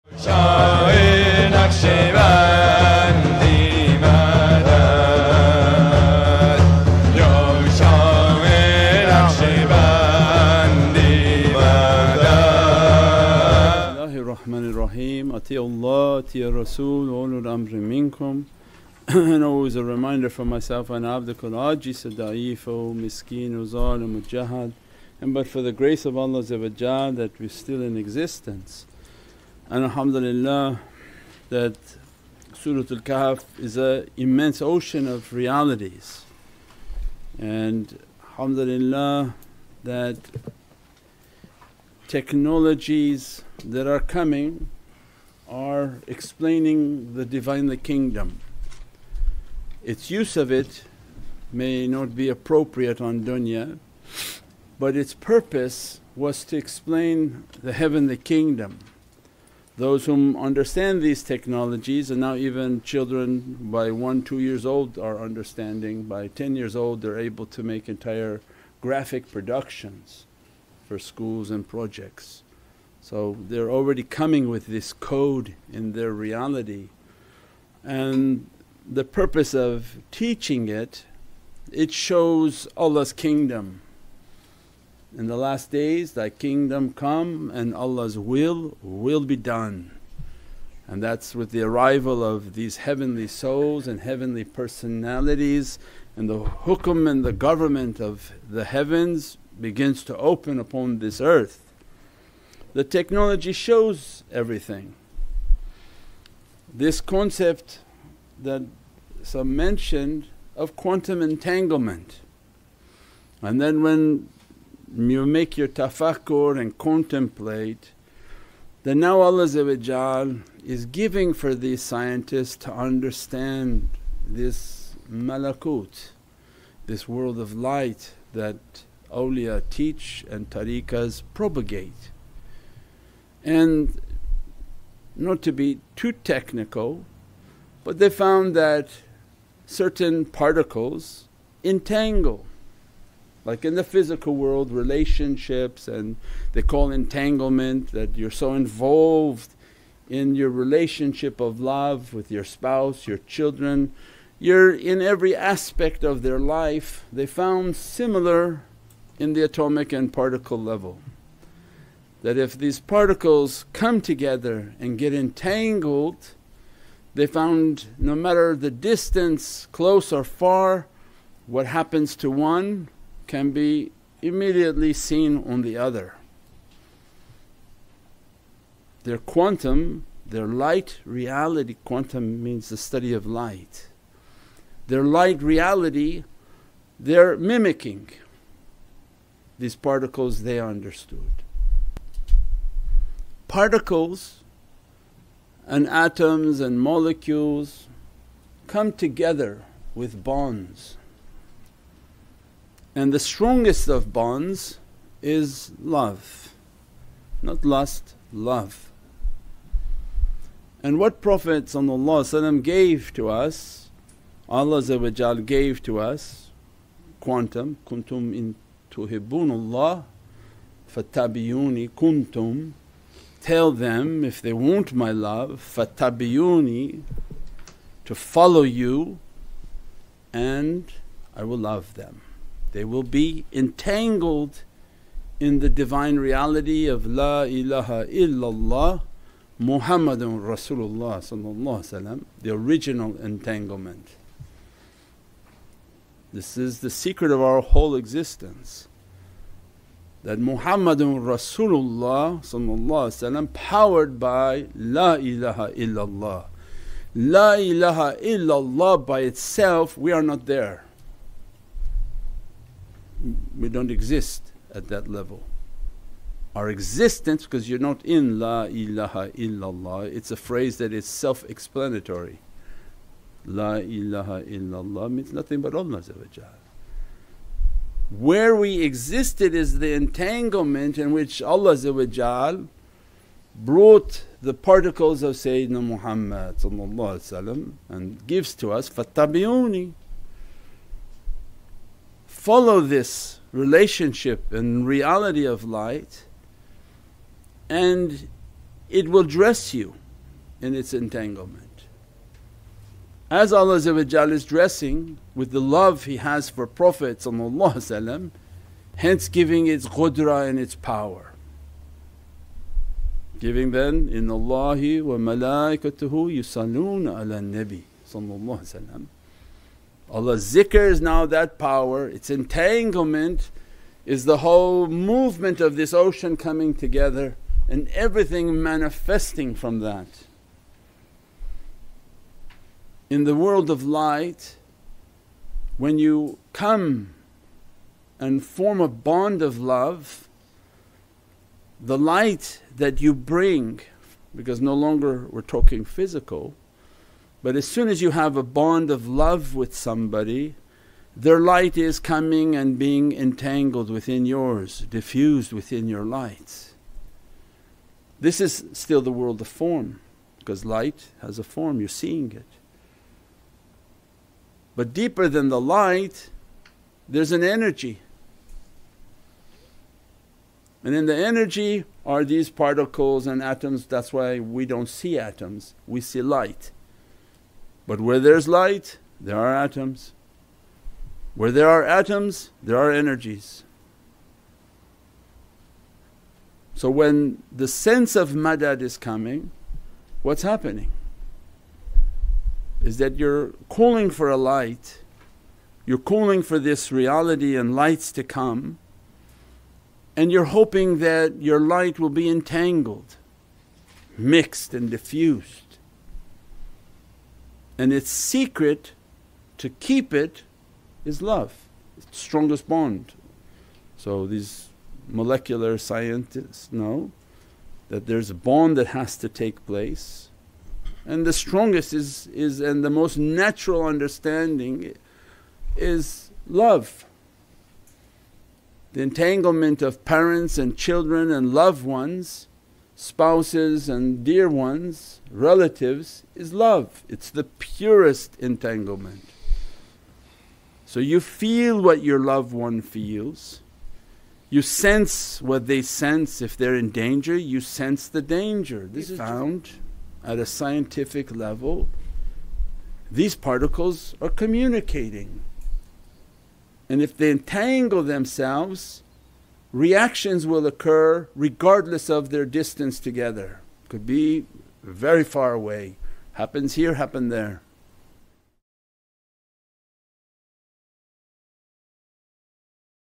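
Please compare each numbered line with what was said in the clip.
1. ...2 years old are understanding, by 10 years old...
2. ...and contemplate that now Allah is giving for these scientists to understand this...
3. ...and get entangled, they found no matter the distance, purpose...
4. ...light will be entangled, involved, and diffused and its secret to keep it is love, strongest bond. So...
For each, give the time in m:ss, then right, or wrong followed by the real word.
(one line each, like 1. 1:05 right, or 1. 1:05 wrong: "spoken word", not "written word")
1. 1:04 right
2. 1:56 right
3. 2:44 wrong: "close", not "purpose"
4. 6:41 wrong: "mixed", not "involved".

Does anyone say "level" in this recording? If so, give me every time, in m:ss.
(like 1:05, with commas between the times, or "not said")
2:40, 4:25, 7:31.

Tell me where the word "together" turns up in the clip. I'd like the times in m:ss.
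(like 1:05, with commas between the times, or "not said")
2:43, 3:18, 5:26, 7:42.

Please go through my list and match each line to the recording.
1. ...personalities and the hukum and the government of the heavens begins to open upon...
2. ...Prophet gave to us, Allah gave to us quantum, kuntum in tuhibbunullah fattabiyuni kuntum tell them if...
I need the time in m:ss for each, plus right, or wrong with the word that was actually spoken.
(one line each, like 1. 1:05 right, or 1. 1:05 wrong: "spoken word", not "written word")
1. 1:34 right
2. 3:31 right.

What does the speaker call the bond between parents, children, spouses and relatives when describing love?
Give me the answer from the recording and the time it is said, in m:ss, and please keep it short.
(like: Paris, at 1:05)
The purest entanglement, at 7:17.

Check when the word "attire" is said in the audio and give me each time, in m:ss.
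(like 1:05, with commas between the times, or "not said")
not said.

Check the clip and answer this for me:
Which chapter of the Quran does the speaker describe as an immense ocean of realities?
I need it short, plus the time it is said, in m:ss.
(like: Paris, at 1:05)
Suratul Kahf, at 0:32.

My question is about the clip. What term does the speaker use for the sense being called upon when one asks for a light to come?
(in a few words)
Madad.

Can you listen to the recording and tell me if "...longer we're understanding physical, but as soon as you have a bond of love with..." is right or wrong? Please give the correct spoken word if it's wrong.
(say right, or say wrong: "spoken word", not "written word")
wrong: "talking", not "understanding".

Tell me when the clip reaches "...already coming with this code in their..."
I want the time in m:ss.
1:13.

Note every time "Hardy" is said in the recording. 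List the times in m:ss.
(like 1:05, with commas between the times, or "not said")
not said.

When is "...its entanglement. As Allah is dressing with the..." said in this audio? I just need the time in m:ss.
5:00.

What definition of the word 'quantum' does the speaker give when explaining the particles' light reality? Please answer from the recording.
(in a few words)
The study of light.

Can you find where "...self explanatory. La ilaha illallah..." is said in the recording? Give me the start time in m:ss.
4:31.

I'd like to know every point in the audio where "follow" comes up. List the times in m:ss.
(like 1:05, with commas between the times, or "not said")
3:48, 4:52.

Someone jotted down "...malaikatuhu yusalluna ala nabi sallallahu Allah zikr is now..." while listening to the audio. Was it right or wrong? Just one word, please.
right.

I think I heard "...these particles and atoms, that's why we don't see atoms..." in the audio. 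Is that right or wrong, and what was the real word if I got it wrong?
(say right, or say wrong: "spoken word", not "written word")
right.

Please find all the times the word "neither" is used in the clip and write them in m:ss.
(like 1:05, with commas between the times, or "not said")
not said.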